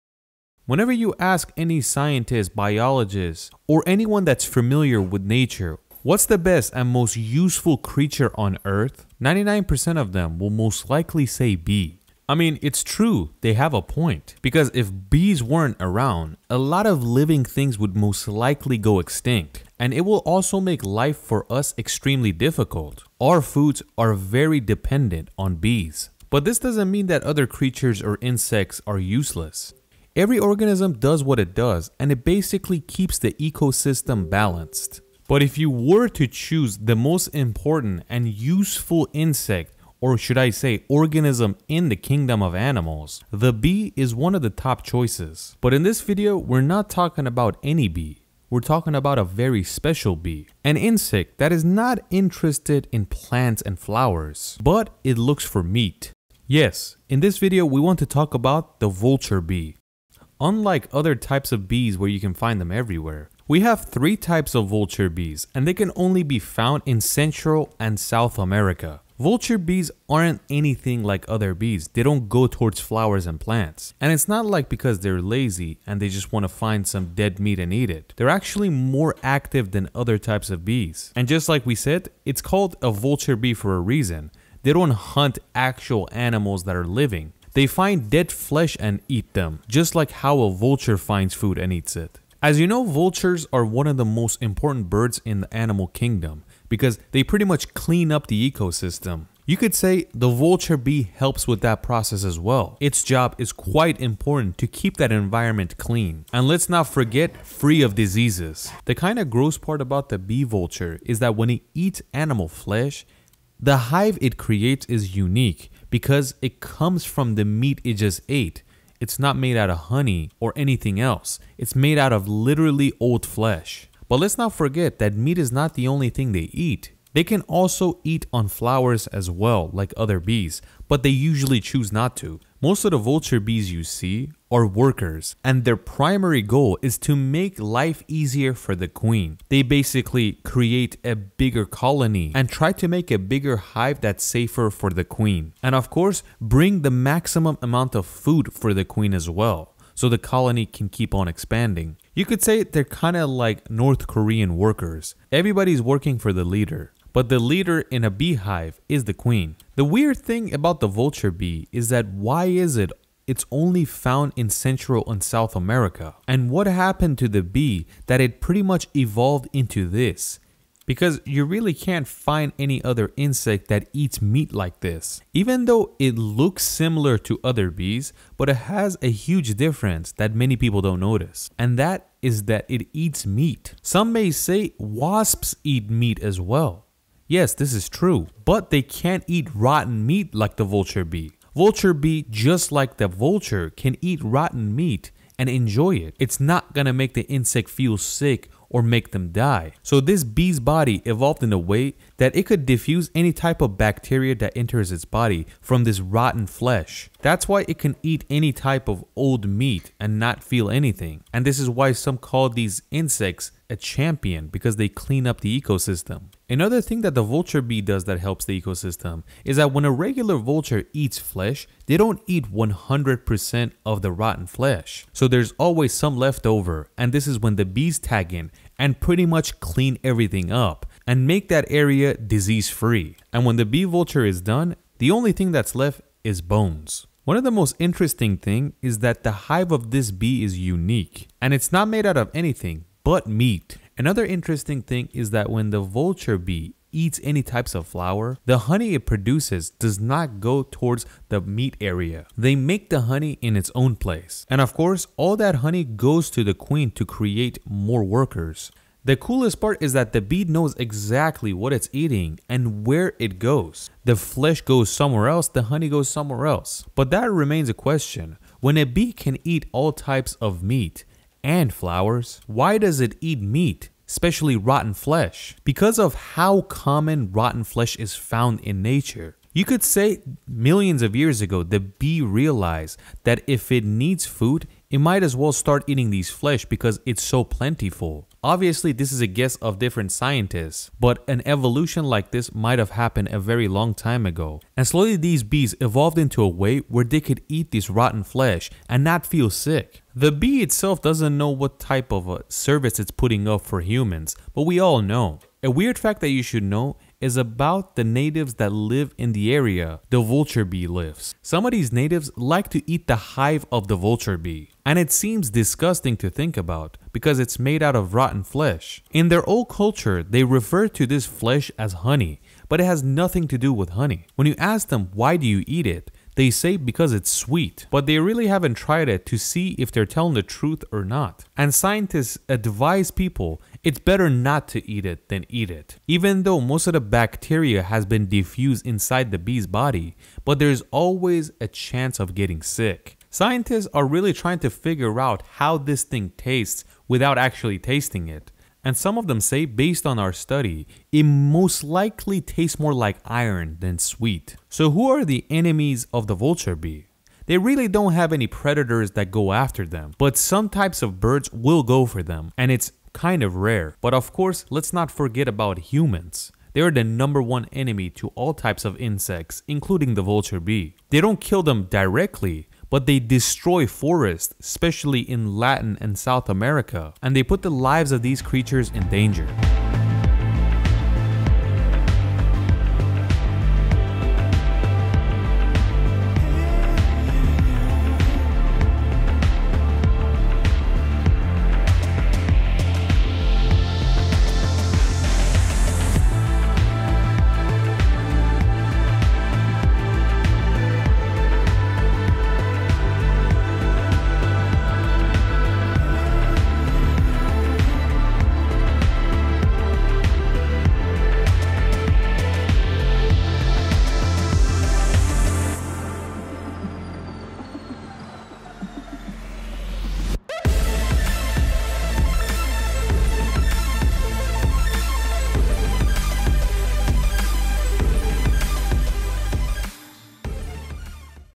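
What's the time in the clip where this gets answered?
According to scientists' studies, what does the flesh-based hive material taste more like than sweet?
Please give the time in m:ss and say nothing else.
5:53.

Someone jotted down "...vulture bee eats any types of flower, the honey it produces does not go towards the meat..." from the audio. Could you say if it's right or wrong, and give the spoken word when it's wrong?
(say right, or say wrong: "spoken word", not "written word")
right.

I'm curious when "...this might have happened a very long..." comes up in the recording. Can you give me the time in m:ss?
4:52.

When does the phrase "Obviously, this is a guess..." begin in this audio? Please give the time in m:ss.
4:48.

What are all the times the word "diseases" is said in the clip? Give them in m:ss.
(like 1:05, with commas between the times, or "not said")
1:47, 3:52.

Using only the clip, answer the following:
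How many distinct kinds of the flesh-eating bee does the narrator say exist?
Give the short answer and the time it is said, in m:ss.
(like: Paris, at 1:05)
3, at 1:03.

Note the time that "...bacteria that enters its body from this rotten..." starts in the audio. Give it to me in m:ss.
3:23.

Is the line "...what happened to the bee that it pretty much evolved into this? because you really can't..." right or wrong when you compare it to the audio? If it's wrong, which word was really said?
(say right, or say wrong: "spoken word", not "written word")
right.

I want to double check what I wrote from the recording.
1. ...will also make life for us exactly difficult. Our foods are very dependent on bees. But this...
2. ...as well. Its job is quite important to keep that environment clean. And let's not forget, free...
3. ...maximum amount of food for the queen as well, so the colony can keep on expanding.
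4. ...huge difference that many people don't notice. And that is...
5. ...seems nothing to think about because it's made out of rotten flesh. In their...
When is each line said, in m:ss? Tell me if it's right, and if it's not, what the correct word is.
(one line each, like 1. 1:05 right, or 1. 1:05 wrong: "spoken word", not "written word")
1. 0:20 wrong: "extremely", not "exactly"
2. 1:42 right
3. 2:26 right
4. 2:59 right
5. 5:15 wrong: "disgusting", not "nothing".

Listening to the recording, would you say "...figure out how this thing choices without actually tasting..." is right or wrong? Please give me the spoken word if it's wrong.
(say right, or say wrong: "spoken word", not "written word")
wrong: "tastes", not "choices".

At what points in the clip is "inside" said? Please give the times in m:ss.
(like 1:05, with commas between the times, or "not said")
5:38.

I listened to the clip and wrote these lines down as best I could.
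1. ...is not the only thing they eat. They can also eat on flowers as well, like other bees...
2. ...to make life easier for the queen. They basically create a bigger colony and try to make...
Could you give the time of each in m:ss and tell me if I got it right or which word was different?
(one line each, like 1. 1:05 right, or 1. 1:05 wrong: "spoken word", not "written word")
1. 2:05 right
2. 2:16 right.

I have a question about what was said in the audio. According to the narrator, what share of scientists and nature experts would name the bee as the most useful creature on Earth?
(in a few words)
99%.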